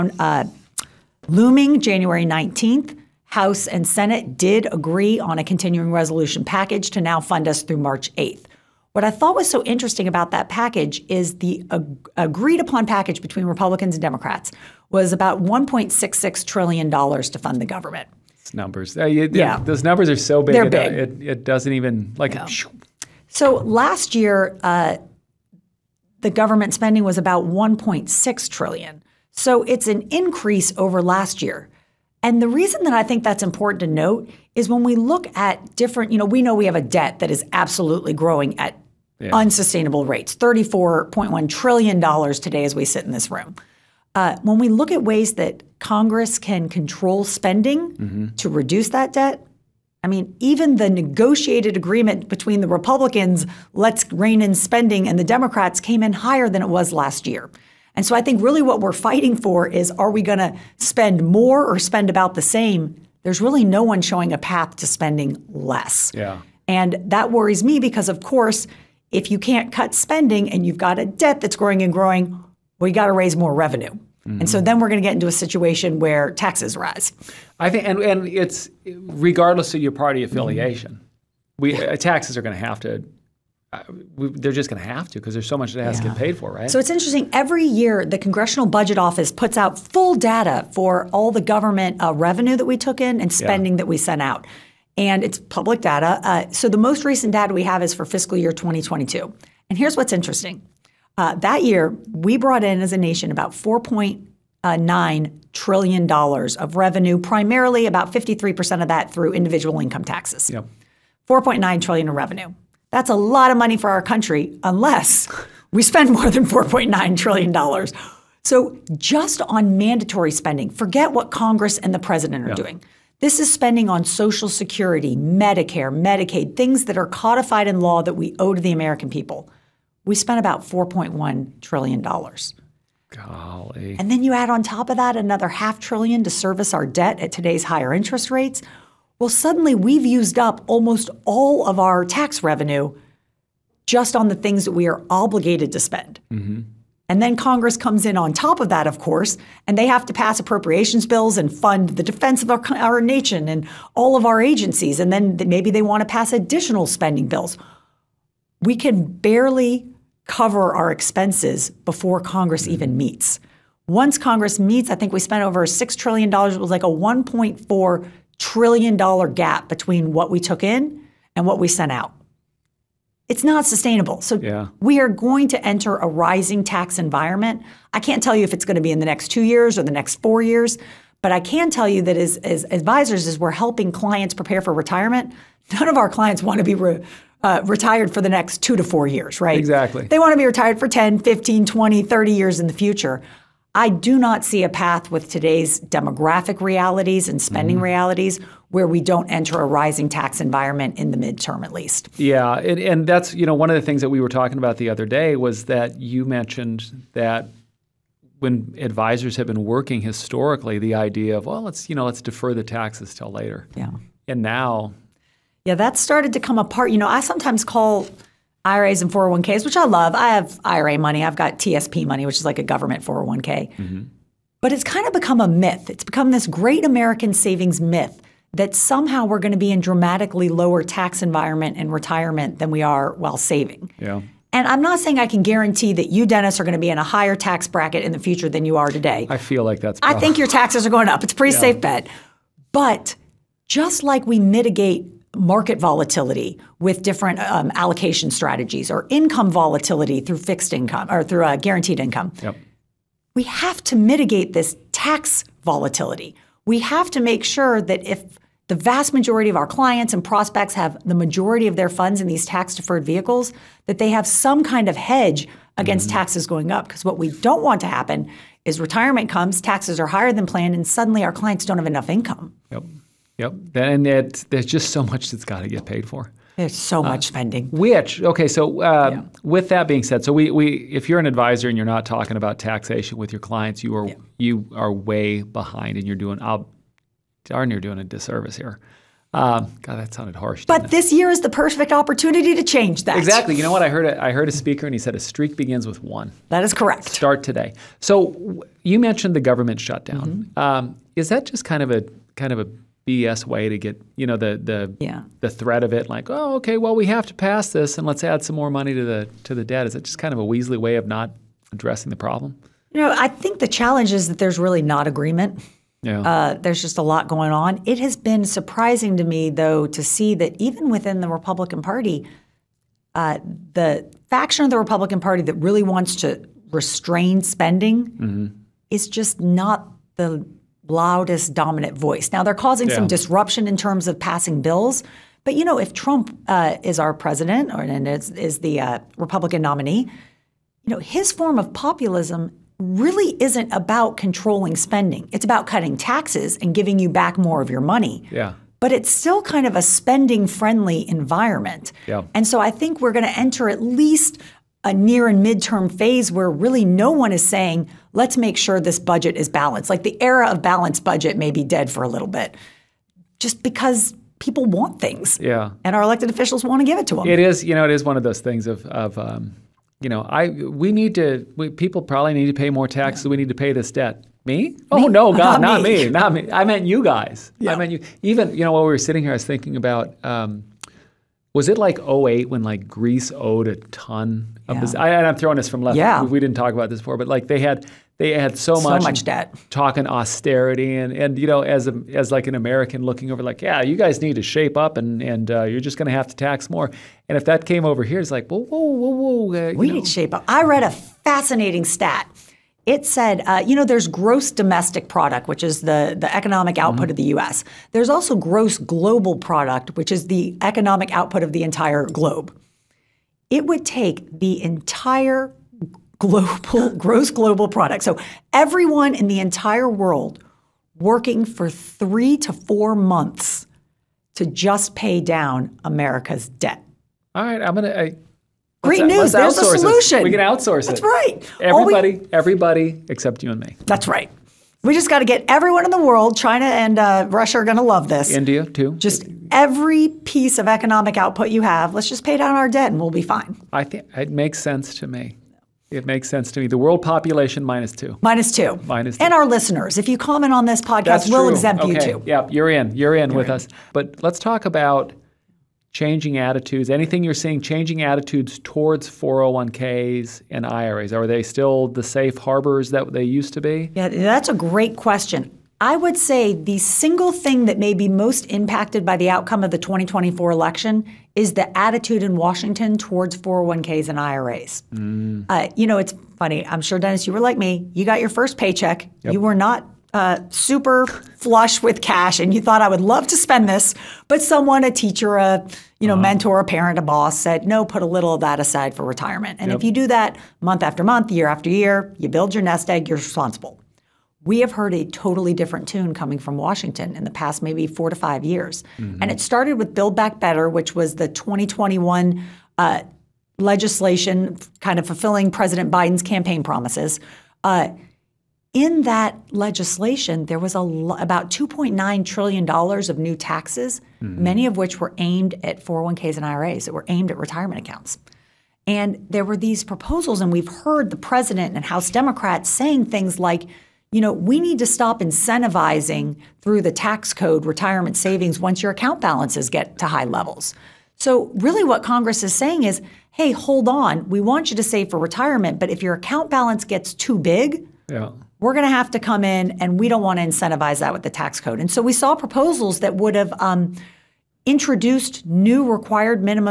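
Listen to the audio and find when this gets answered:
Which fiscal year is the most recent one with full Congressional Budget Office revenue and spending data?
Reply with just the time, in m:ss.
1:38.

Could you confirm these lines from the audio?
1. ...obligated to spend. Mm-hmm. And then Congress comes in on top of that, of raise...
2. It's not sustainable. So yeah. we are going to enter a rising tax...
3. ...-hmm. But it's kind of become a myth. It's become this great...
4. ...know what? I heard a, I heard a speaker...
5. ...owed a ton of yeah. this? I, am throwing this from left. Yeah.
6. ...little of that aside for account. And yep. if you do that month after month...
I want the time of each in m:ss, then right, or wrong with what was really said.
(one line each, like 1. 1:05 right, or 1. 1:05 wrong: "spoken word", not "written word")
1. 2:25 wrong: "course", not "raise"
2. 2:53 right
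3. 3:43 right
4. 4:53 right
5. 6:23 right
6. 8:08 wrong: "retirement", not "account".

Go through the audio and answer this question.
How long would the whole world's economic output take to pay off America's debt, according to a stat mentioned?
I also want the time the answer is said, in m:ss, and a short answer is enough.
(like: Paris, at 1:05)
3 to 4 months, at 7:01.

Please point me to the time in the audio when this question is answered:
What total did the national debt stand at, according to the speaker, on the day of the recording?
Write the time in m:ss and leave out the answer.
0:40.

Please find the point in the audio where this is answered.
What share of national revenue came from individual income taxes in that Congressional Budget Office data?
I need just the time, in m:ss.
1:48.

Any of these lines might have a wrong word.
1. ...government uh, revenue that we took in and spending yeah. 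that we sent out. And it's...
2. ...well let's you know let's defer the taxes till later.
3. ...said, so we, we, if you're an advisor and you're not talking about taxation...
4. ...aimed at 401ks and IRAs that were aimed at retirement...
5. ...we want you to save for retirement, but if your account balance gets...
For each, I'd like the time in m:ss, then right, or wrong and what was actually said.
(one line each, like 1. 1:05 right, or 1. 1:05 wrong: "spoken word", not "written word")
1. 1:31 right
2. 3:31 right
3. 4:40 right
4. 8:35 right
5. 8:54 right.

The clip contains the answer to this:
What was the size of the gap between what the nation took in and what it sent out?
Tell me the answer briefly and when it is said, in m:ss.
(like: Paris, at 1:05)
$1.4 trillion, at 2:46.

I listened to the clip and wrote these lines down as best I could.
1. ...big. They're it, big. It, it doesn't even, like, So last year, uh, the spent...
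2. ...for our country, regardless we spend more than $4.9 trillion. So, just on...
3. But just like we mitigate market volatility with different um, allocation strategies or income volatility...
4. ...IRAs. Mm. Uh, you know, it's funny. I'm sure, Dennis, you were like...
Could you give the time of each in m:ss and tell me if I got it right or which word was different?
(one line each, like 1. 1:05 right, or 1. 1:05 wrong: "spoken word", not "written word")
1. 0:20 wrong: "government", not "spent"
2. 1:53 wrong: "unless", not "regardless"
3. 4:02 right
4. 7:54 right.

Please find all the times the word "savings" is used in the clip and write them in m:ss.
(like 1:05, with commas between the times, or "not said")
3:47, 3:53, 8:48.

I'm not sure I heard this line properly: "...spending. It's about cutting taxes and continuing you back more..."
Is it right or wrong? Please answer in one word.
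wrong.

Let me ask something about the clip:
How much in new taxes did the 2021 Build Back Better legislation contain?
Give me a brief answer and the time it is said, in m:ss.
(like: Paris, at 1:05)
$2.9 trillion, at 8:31.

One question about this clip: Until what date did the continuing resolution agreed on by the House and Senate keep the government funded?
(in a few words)
March 8th.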